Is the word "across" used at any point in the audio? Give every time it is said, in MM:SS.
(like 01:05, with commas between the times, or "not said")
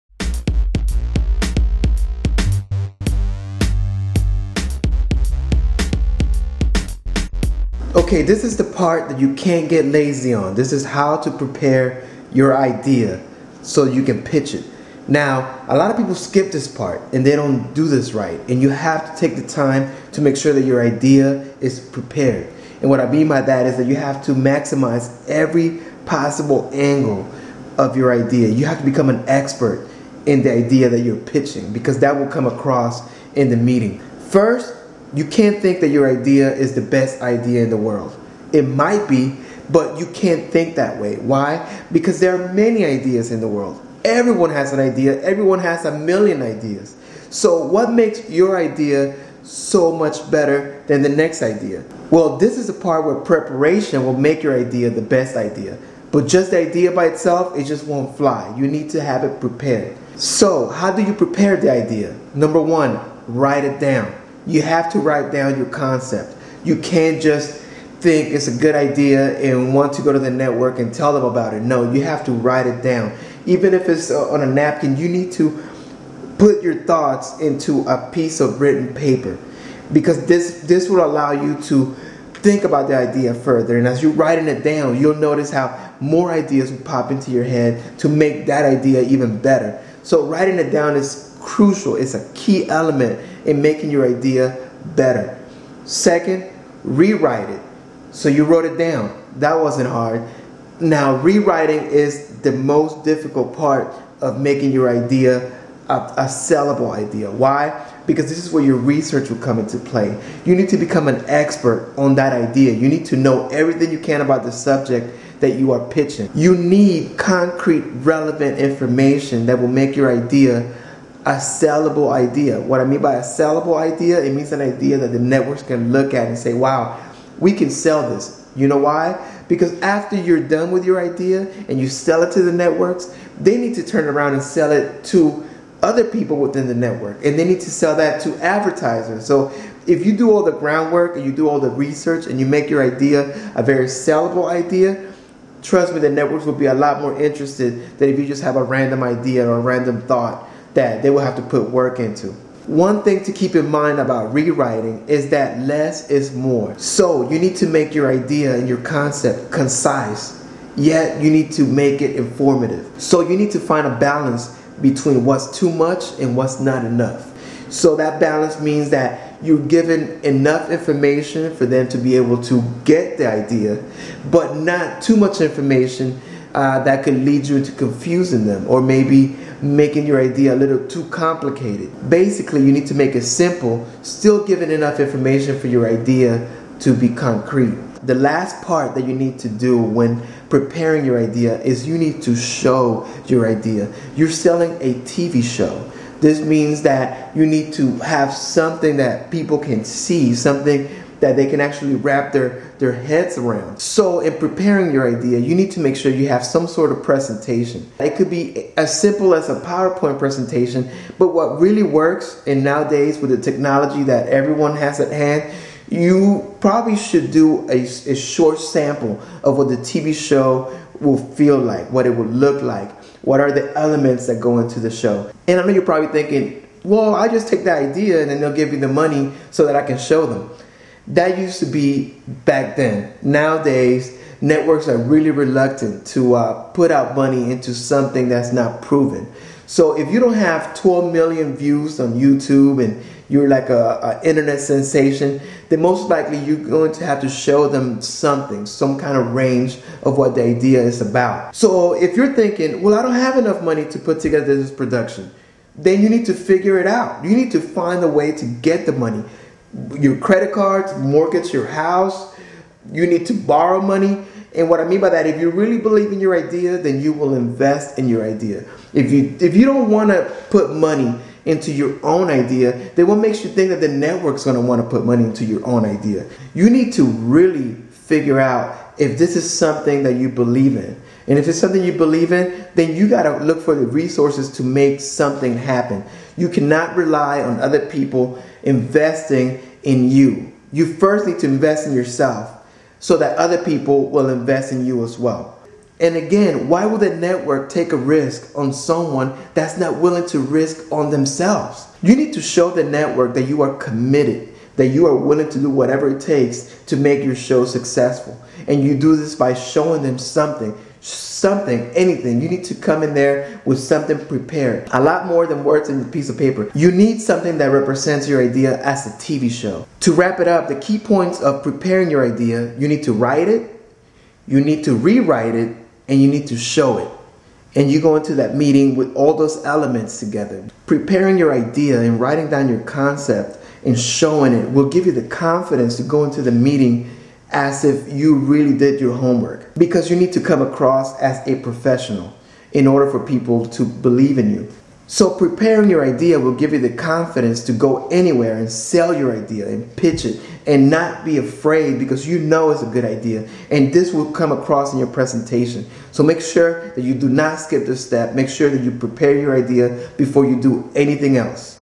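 00:32, 05:40, 05:54.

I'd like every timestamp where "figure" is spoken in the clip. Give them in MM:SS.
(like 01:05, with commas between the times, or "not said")
04:16, 04:37.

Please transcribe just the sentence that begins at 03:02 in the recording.
Basically, you need to make it simple, still giving enough information for your idea to be concrete.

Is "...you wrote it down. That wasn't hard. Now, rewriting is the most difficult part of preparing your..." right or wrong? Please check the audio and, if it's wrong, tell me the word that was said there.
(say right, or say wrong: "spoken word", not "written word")
wrong: "making", not "preparing".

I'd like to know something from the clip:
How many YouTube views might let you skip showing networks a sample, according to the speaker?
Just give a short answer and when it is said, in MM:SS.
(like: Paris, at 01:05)
12 million, at 04:00.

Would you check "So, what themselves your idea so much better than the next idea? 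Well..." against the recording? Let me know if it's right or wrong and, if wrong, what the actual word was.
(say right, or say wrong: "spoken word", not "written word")
wrong: "makes", not "themselves".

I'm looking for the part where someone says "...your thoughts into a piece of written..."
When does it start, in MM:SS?
01:16.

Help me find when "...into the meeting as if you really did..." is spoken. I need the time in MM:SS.
05:36.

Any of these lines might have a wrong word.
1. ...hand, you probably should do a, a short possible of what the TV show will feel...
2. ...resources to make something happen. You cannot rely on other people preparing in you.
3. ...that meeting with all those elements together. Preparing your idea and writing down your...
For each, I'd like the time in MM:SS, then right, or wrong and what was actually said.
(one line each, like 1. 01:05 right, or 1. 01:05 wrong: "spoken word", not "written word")
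1. 03:35 wrong: "sample", not "possible"
2. 04:43 wrong: "investing", not "preparing"
3. 05:28 right.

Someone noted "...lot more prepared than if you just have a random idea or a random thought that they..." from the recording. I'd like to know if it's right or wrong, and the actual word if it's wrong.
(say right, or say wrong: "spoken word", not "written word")
wrong: "interested", not "prepared".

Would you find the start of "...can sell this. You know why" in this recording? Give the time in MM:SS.
02:07.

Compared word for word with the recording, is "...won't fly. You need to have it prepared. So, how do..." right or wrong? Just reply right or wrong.
right.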